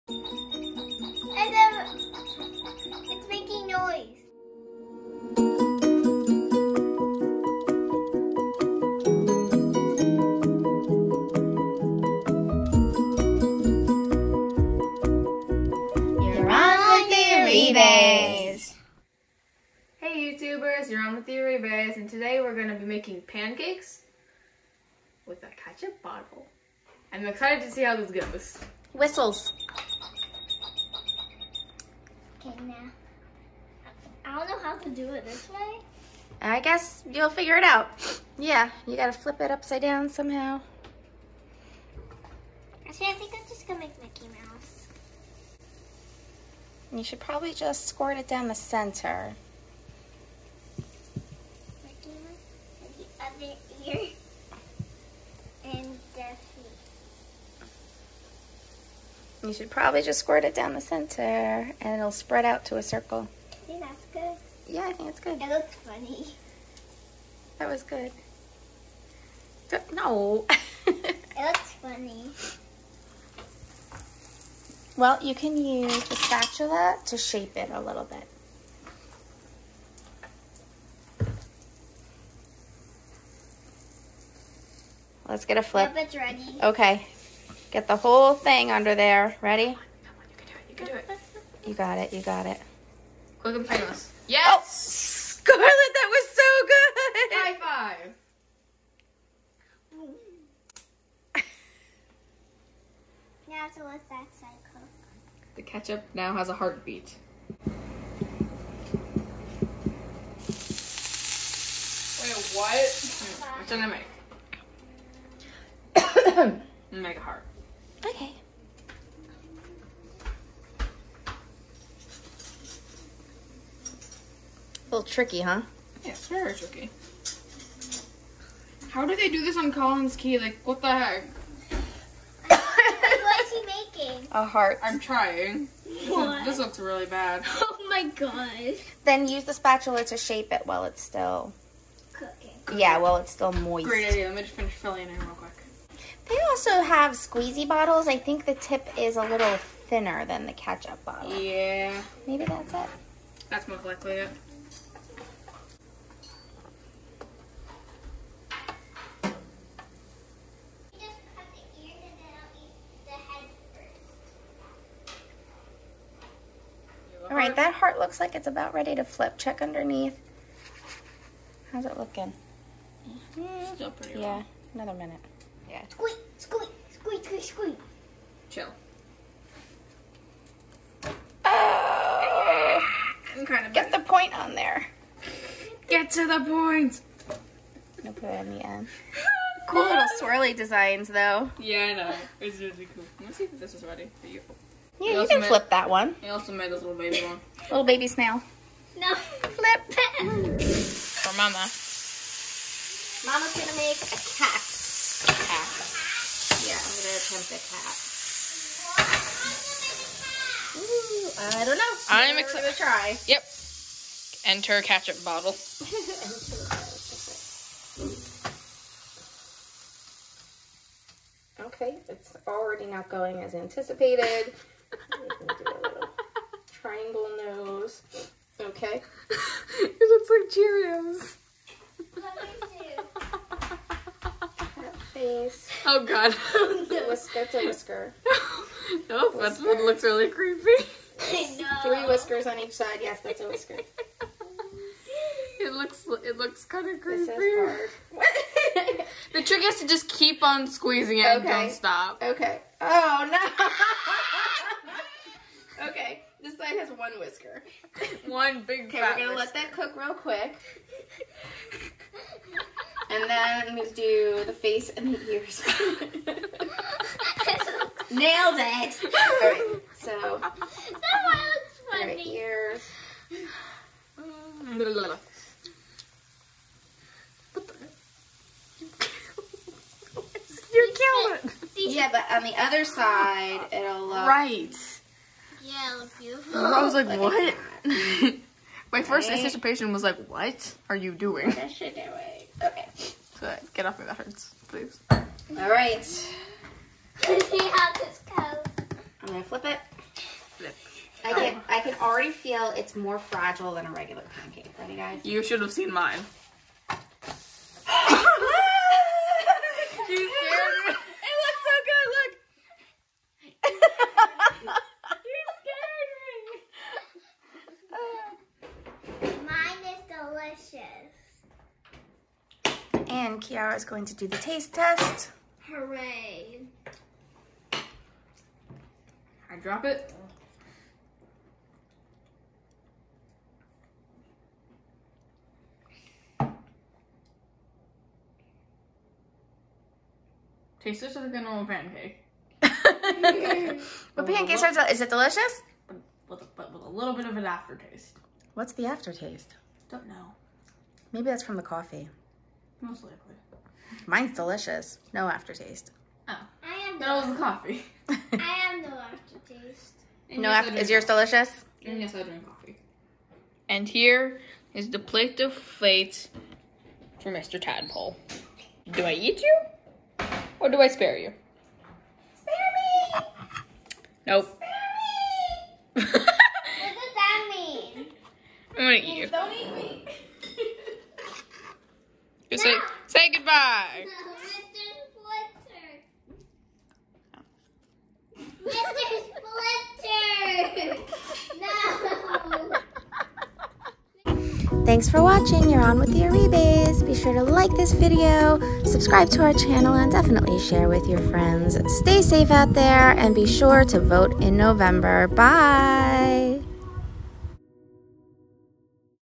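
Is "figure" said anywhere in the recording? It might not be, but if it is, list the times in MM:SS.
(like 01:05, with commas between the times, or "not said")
00:37.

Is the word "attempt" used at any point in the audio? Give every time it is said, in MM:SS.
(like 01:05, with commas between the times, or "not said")
03:27.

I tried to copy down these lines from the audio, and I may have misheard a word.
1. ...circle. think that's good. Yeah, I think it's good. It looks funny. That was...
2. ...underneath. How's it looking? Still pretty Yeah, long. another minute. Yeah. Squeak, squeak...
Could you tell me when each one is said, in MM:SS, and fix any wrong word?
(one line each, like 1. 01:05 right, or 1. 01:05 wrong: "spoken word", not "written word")
1. 01:02 right
2. 02:49 right.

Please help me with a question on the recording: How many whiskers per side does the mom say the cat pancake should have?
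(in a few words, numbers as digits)
3.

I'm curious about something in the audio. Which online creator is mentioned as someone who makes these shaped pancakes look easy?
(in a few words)
Collins Key.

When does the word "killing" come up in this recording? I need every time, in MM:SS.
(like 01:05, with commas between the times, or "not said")
04:40.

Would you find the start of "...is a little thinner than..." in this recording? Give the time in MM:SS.
02:28.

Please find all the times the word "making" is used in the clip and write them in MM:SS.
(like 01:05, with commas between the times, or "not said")
00:22, 02:14.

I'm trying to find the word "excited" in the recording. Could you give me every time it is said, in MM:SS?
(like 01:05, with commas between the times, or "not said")
00:27, 03:32.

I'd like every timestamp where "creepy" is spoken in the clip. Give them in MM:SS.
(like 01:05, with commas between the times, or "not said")
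04:00, 04:07.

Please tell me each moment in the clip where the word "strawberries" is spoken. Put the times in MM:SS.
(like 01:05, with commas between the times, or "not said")
not said.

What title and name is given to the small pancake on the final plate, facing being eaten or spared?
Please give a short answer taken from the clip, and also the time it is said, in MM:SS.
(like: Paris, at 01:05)
Mr. Tadpole, at 06:07.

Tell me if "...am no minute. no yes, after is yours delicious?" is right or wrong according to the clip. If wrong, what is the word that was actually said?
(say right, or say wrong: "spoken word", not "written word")
wrong: "aftertaste", not "minute".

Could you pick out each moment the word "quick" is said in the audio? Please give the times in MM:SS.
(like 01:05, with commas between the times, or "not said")
01:33, 02:25, 04:20.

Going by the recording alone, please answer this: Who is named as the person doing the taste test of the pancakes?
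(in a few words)
Kiara.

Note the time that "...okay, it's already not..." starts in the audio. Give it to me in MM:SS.
03:41.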